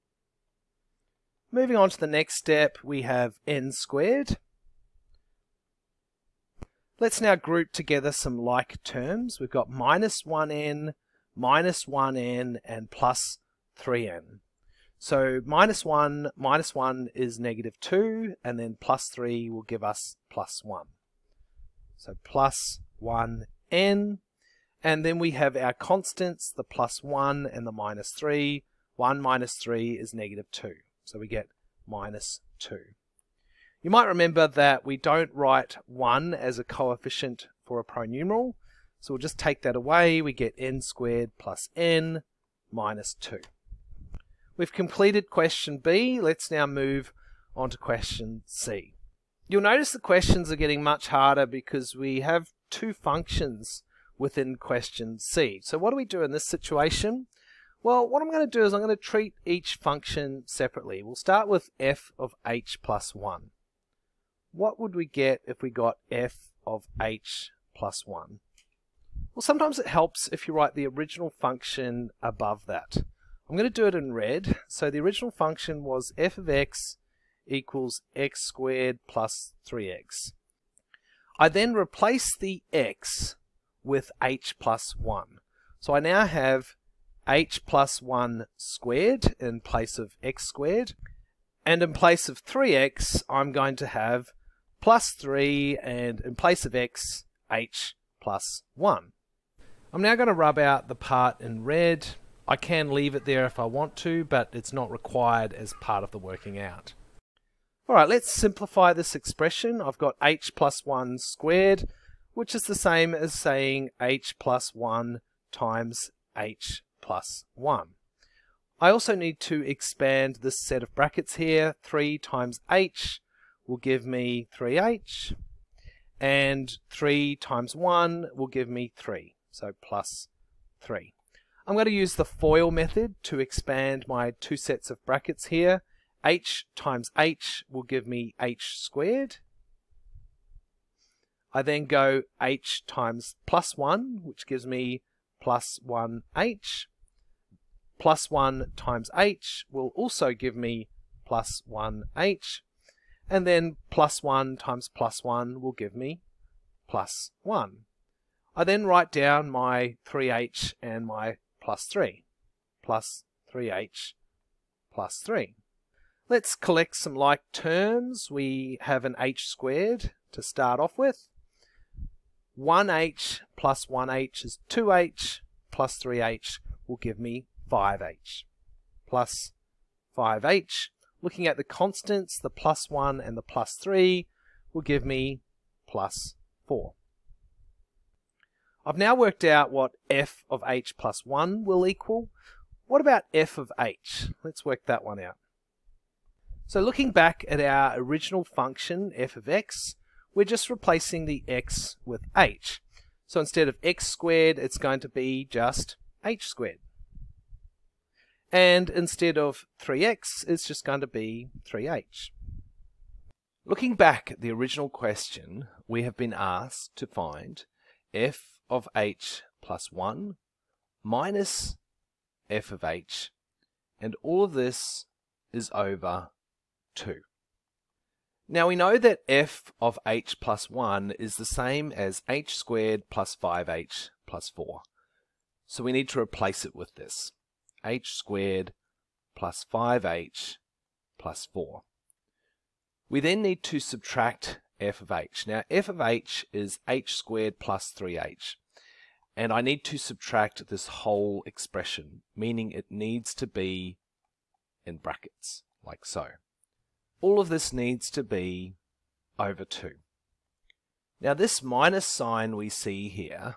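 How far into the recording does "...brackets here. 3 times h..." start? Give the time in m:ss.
2:00.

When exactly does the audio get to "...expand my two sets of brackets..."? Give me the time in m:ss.
2:13.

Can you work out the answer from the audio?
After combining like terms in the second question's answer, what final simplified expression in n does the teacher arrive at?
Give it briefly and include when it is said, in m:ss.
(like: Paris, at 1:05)
n squared plus n minus 2, at 0:40.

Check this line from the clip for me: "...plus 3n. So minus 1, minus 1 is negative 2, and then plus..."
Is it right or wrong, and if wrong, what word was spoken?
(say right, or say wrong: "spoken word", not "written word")
right.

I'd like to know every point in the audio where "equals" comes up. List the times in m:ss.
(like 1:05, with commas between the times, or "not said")
1:17, 3:11.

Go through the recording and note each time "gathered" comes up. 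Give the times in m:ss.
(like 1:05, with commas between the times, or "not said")
not said.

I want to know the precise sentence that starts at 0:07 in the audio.
Let's now group together some like terms.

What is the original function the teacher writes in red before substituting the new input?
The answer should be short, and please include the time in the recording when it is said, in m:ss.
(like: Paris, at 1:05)
x squared plus 3x, at 1:18.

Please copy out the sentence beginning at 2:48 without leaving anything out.
We have an h squared to start off with.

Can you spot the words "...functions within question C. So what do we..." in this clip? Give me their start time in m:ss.
0:52.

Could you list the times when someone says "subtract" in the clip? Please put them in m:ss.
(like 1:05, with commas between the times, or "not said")
4:03, 4:09.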